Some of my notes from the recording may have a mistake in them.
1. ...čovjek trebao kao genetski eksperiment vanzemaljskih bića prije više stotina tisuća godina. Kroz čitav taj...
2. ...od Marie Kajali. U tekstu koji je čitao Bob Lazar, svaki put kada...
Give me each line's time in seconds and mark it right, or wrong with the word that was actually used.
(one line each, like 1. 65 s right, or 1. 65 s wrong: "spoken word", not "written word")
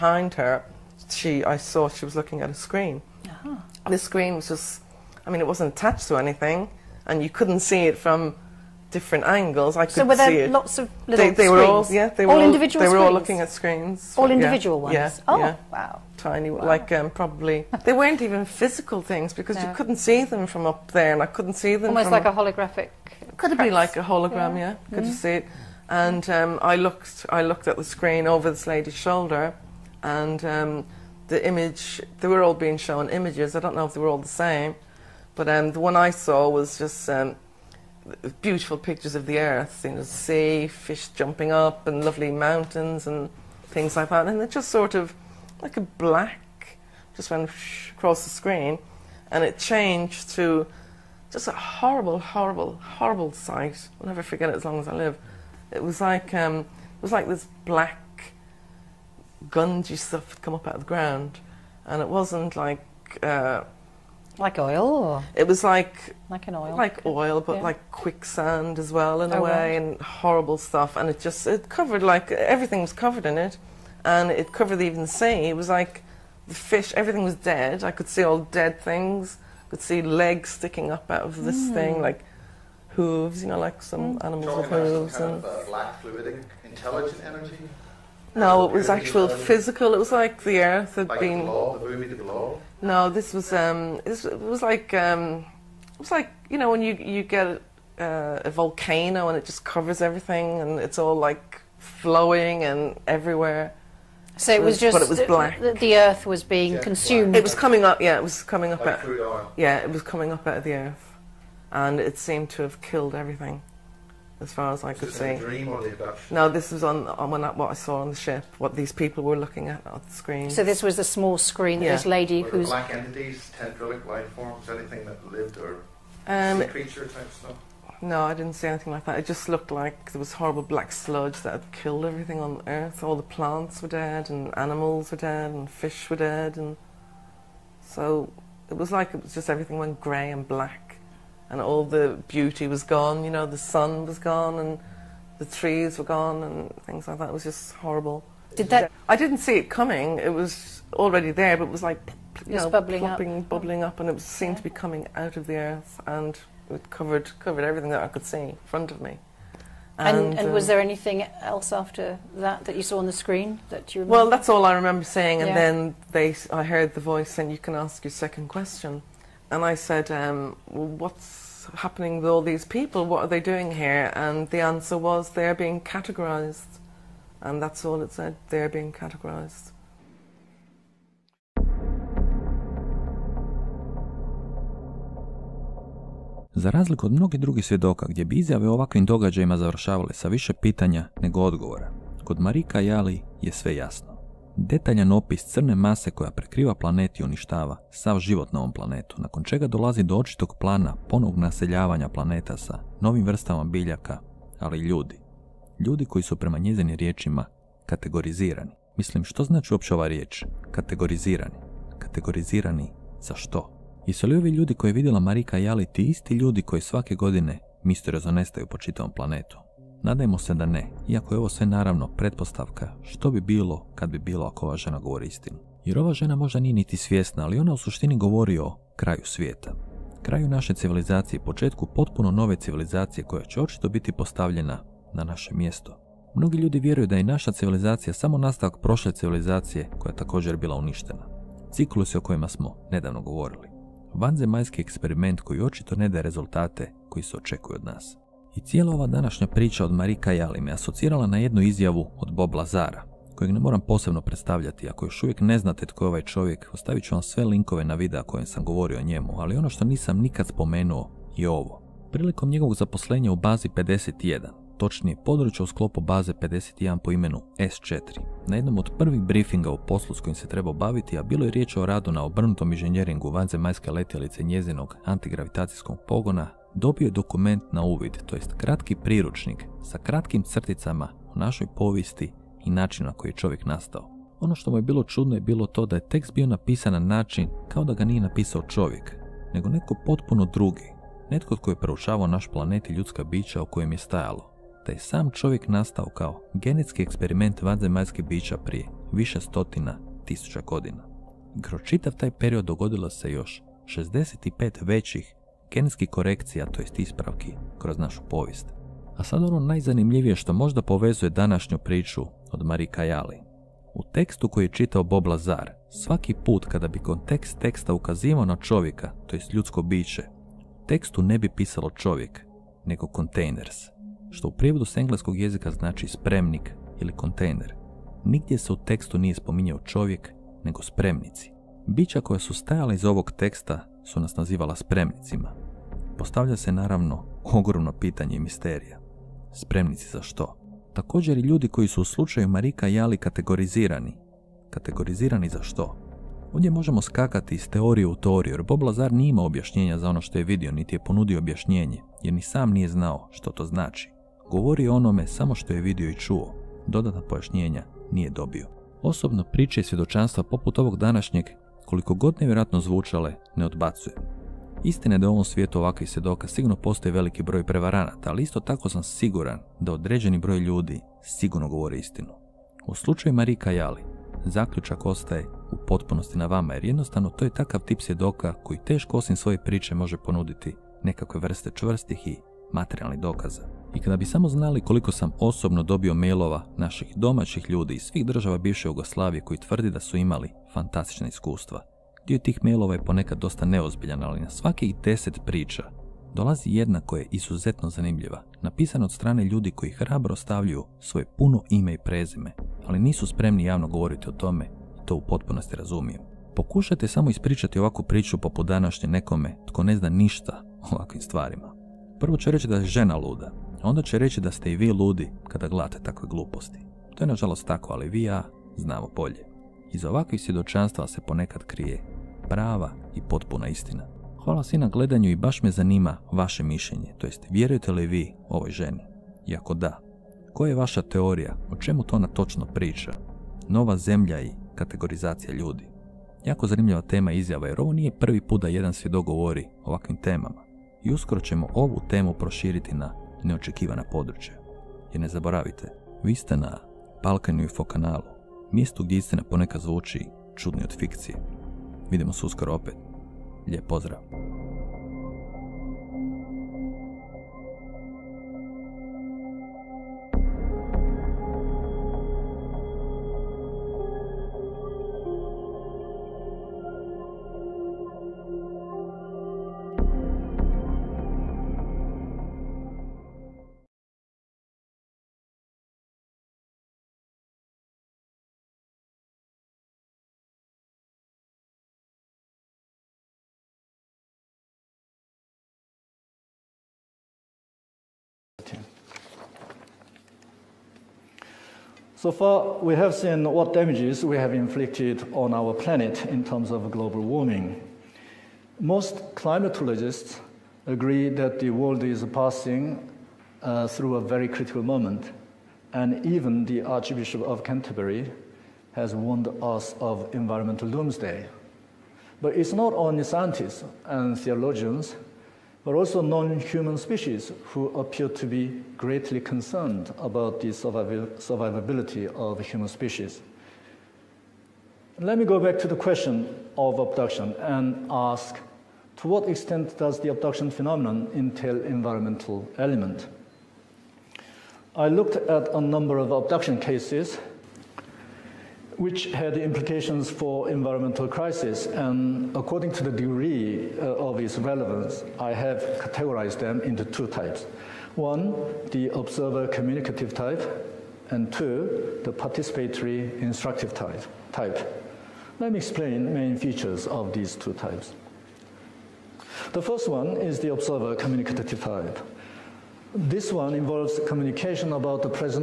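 1. 295 s wrong: "nastao", not "trebao"
2. 312 s right.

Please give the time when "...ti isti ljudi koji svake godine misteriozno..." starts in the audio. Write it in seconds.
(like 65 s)
215 s.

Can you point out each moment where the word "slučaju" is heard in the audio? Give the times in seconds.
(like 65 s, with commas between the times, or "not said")
342 s, 372 s.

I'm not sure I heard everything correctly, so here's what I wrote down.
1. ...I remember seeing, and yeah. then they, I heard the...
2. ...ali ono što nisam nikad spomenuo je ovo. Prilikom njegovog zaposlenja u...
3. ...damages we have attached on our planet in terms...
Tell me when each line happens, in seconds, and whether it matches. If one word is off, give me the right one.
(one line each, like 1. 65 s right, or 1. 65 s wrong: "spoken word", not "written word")
1. 164 s right
2. 259 s right
3. 493 s wrong: "inflicted", not "attached".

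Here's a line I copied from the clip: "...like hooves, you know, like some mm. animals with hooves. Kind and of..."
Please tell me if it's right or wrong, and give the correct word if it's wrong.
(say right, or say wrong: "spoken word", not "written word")
right.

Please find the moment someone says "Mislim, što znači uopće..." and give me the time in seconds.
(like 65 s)
208 s.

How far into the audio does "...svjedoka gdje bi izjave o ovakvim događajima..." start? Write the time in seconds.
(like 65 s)
187 s.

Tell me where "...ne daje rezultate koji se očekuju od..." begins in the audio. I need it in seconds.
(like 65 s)
245 s.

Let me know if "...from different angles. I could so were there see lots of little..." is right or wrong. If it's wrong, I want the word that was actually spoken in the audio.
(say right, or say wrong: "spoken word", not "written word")
right.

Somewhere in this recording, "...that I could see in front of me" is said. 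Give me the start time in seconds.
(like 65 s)
157 s.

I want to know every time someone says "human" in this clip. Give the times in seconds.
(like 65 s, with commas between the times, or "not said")
516 s, 522 s.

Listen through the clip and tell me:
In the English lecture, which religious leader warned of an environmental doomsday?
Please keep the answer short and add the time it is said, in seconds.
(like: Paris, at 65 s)
Archbishop of Canterbury, at 506 s.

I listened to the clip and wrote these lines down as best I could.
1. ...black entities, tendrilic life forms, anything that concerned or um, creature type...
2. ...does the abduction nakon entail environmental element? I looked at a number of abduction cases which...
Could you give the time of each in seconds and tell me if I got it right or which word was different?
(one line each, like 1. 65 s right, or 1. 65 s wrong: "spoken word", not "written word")
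1. 122 s wrong: "lived", not "concerned"
2. 529 s wrong: "phenomenon", not "nakon".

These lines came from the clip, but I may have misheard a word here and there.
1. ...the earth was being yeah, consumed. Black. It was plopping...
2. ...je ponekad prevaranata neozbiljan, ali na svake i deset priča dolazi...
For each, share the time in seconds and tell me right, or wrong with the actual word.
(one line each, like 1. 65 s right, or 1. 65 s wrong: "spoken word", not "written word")
1. 105 s wrong: "coming", not "plopping"
2. 392 s wrong: "dosta", not "prevaranata".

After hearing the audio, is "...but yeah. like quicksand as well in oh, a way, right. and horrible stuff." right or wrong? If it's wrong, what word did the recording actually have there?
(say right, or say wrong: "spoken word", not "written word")
right.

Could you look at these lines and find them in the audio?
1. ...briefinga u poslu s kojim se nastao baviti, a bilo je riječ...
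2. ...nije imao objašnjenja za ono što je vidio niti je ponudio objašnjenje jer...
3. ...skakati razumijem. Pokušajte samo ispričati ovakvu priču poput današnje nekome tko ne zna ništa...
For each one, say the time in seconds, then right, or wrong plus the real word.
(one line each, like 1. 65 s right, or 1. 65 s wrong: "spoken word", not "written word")
1. 269 s wrong: "trebao", not "nastao"
2. 349 s right
3. 405 s wrong: "potpunosti", not "skakati".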